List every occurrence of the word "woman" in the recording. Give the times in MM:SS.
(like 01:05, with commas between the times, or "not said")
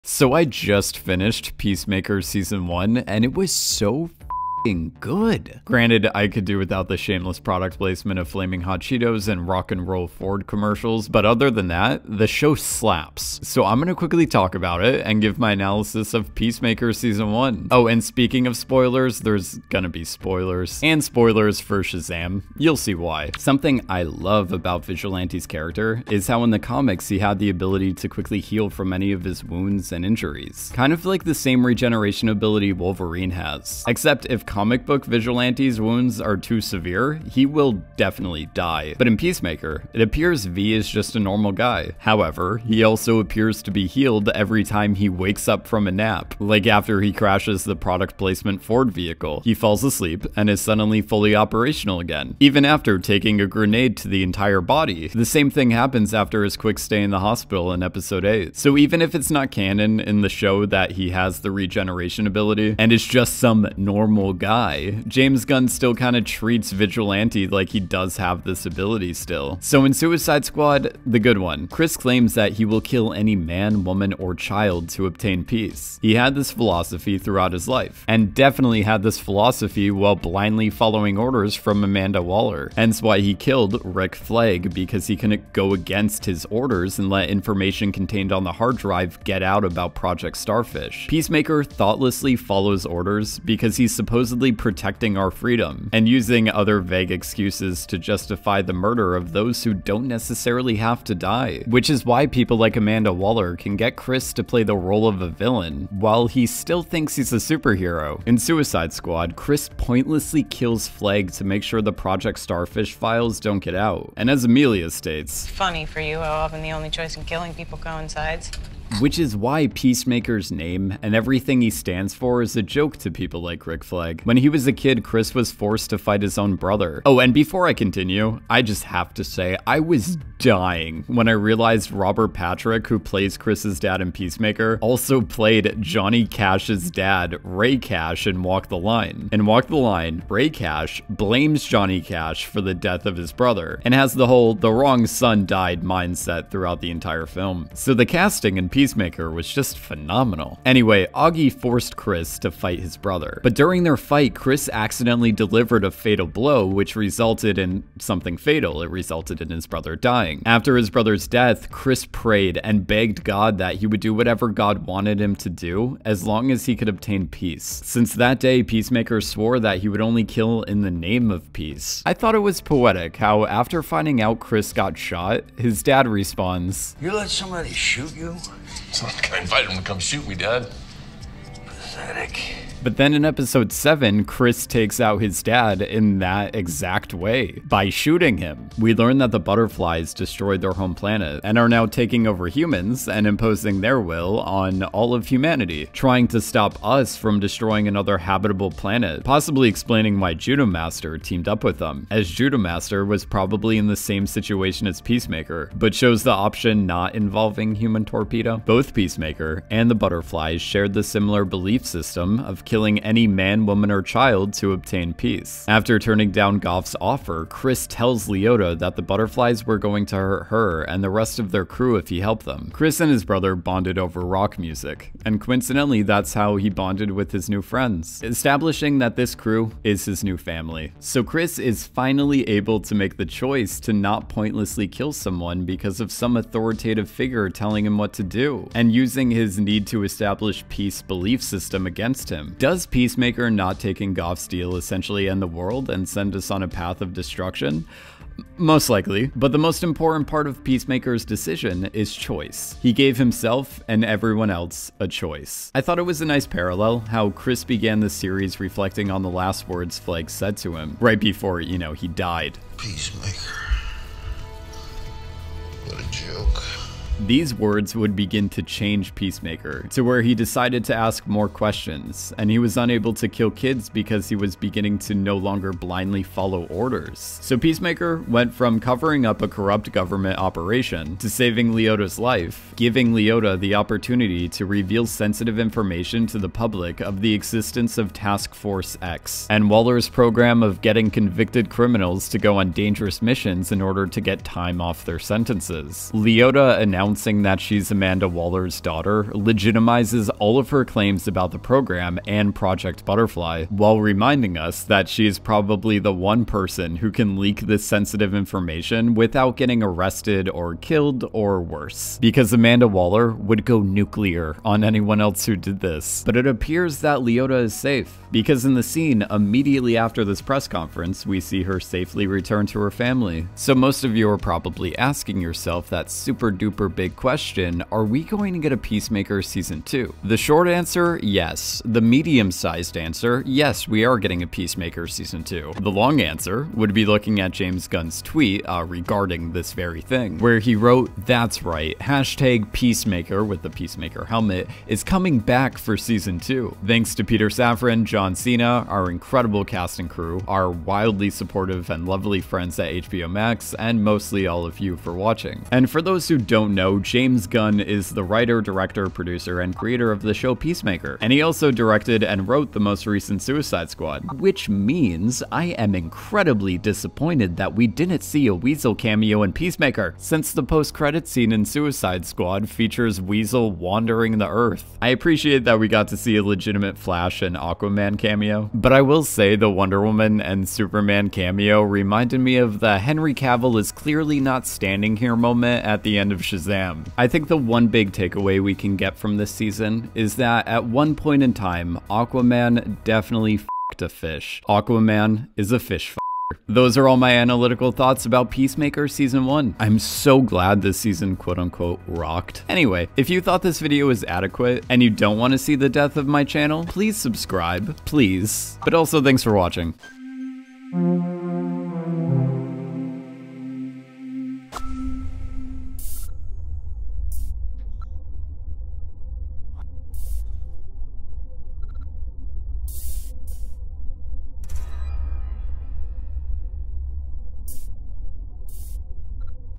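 01:13, 03:33, 06:20.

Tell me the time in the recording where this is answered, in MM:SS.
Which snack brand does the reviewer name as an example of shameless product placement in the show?
00:08.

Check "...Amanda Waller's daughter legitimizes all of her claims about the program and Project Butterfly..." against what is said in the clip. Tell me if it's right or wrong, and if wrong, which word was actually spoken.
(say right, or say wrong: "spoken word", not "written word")
right.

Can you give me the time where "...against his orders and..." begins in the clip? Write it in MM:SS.
01:25.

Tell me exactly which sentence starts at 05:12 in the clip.
Because Amanda Waller would go nuclear on anyone else who did this.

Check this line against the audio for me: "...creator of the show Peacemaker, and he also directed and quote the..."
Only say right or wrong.
wrong.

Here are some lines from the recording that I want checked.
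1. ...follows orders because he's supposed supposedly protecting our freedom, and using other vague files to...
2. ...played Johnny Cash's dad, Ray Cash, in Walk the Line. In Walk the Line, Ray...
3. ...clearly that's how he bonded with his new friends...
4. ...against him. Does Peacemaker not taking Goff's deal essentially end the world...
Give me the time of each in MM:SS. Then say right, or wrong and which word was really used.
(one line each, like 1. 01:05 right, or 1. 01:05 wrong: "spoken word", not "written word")
1. 01:32 wrong: "excuses", not "files"
2. 02:15 right
3. 03:45 wrong: "coincidentally", not "clearly"
4. 04:01 right.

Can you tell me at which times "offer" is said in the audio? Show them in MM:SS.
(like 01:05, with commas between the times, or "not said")
03:37.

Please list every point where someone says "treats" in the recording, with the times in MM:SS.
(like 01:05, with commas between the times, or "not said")
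01:06.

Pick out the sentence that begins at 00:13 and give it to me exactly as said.
So I'm gonna quickly talk about it and give my analysis of Peacemaker Season 1.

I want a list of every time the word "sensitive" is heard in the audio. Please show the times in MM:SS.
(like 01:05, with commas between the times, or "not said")
04:45, 05:07.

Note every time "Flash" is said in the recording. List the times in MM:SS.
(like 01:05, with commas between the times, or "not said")
06:16.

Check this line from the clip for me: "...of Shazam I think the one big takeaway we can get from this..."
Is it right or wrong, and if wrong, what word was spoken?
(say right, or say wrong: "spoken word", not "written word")
right.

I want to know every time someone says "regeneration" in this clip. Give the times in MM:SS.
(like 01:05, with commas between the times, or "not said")
00:31, 01:01.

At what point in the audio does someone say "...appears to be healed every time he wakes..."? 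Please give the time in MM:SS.
00:43.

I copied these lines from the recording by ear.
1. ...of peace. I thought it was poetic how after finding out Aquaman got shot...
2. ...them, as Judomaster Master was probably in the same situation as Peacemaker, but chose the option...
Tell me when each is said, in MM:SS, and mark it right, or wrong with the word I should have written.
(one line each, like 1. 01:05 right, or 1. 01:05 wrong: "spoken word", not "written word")
1. 02:51 wrong: "Chris", not "Aquaman"
2. 03:21 right.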